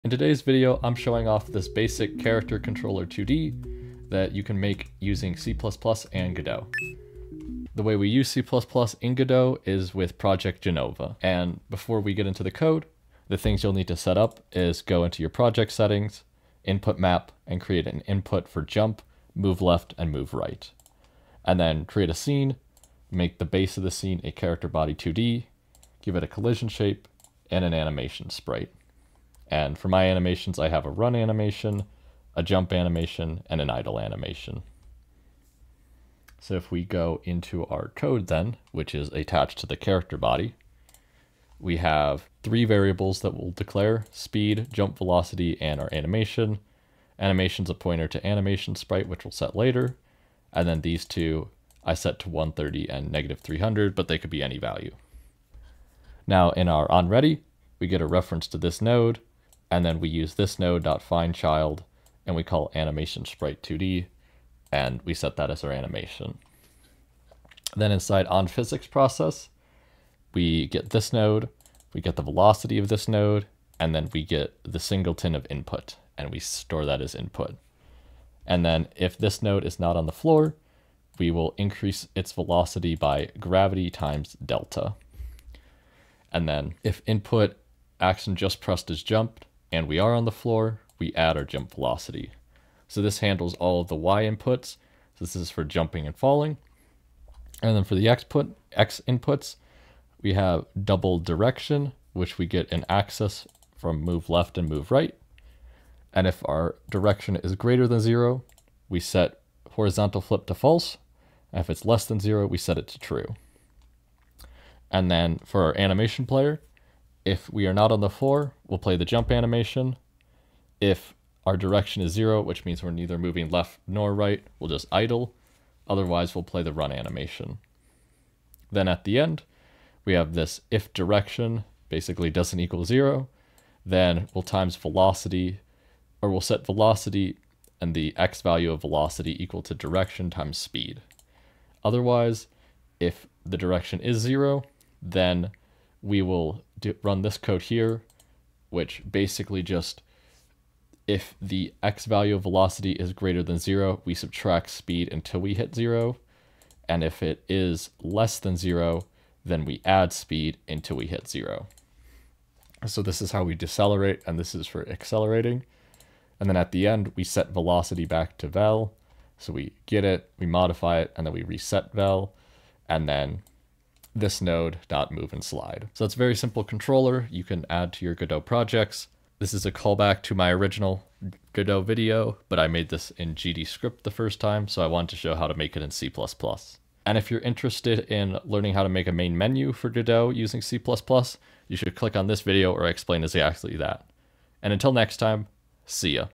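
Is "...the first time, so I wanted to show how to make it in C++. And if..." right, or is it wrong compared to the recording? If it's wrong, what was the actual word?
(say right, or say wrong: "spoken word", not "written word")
right.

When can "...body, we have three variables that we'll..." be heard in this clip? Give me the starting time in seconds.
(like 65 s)
40 s.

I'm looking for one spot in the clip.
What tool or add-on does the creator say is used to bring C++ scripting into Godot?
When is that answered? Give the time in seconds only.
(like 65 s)
10 s.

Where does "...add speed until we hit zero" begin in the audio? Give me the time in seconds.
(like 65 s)
159 s.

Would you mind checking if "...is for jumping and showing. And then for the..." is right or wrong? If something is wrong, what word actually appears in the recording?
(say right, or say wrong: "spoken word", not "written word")
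wrong: "falling", not "showing".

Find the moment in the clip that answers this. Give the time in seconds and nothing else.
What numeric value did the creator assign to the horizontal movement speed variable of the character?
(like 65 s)
52 s.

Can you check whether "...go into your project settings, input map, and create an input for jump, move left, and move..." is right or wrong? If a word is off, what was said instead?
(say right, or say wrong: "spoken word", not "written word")
right.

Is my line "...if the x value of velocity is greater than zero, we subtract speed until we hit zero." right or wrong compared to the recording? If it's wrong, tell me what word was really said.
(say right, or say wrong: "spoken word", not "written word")
right.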